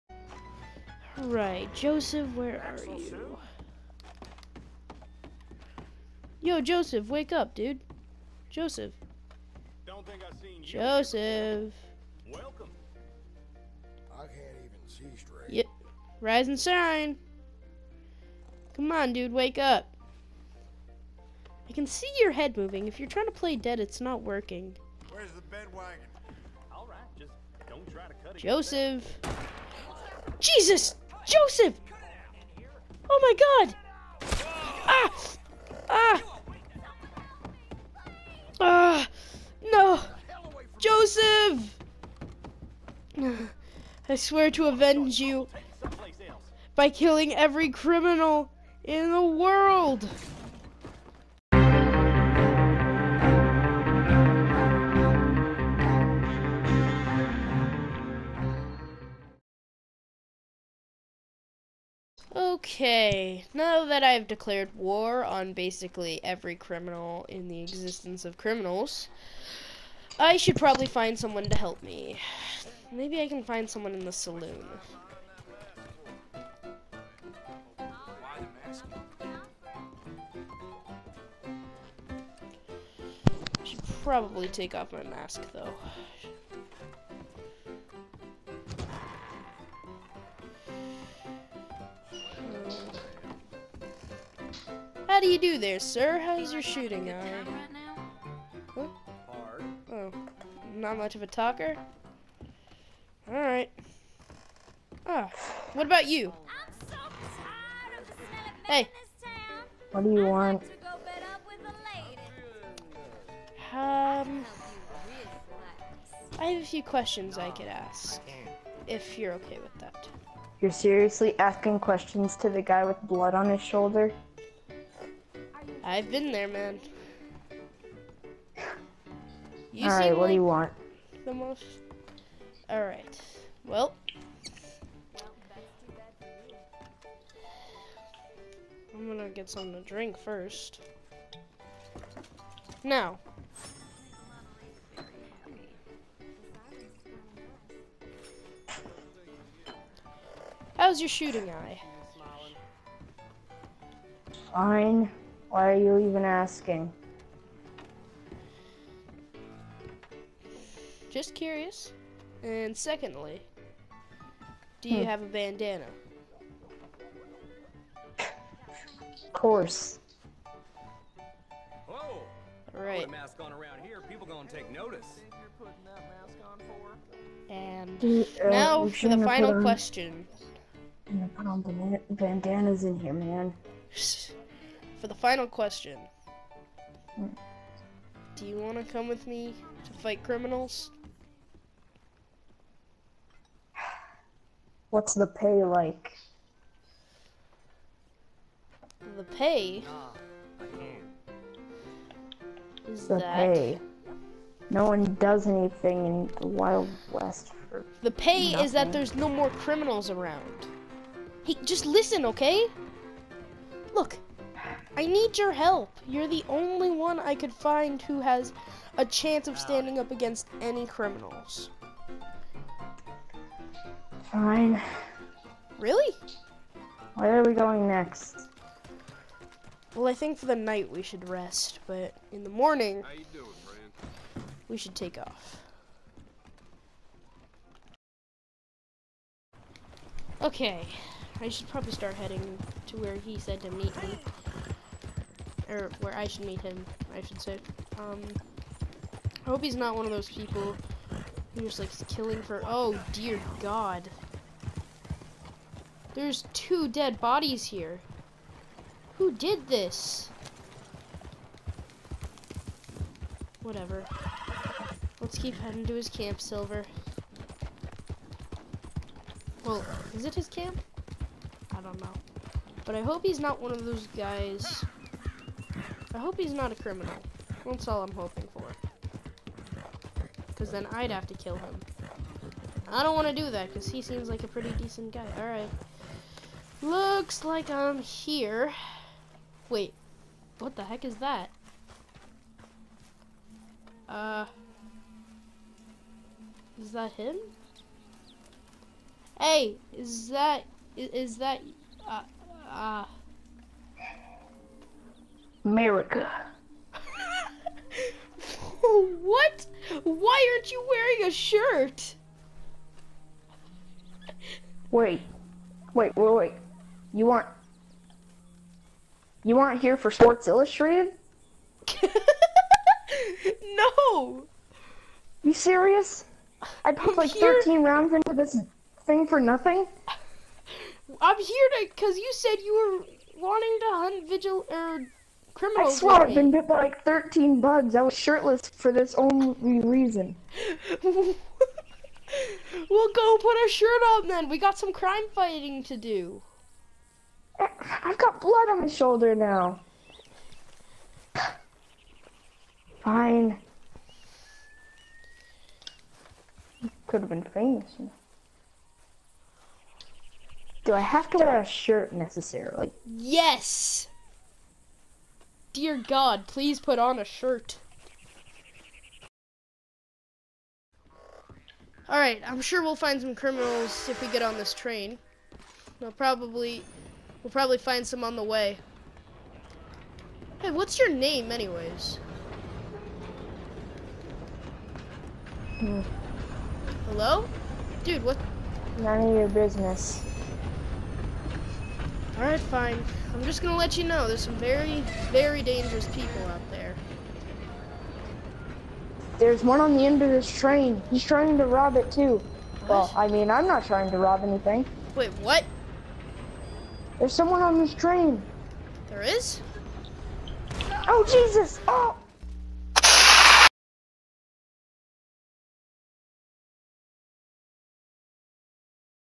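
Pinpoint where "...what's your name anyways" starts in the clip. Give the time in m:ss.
6:20.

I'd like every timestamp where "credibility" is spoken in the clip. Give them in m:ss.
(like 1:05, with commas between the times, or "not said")
not said.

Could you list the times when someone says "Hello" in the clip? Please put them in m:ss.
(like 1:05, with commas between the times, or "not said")
6:27.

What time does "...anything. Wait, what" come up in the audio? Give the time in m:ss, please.
6:44.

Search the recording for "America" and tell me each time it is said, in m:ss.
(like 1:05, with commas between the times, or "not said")
5:05.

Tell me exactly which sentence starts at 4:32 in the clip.
But I hope he's not one of those guys I hope he's not a criminal.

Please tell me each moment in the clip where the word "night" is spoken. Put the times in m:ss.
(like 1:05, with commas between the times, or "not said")
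3:50.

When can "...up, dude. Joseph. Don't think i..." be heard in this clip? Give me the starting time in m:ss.
0:07.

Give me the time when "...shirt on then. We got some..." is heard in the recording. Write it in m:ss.
5:43.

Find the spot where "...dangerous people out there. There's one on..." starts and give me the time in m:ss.
6:35.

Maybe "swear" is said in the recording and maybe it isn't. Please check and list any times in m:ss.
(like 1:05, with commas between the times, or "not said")
0:44, 5:35.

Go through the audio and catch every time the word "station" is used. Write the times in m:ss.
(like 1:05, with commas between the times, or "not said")
not said.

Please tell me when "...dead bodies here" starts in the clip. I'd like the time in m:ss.
4:16.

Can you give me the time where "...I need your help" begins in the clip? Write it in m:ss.
3:34.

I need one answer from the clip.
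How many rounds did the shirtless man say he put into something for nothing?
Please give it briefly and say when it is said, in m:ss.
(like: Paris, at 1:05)
13, at 5:27.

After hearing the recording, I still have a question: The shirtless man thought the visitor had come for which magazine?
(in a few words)
Sports Illustrated.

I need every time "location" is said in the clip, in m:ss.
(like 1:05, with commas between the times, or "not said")
not said.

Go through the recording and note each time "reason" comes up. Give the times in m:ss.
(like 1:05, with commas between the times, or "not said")
5:39.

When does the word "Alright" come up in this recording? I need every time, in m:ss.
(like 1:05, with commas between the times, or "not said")
4:45, 6:12, 6:32.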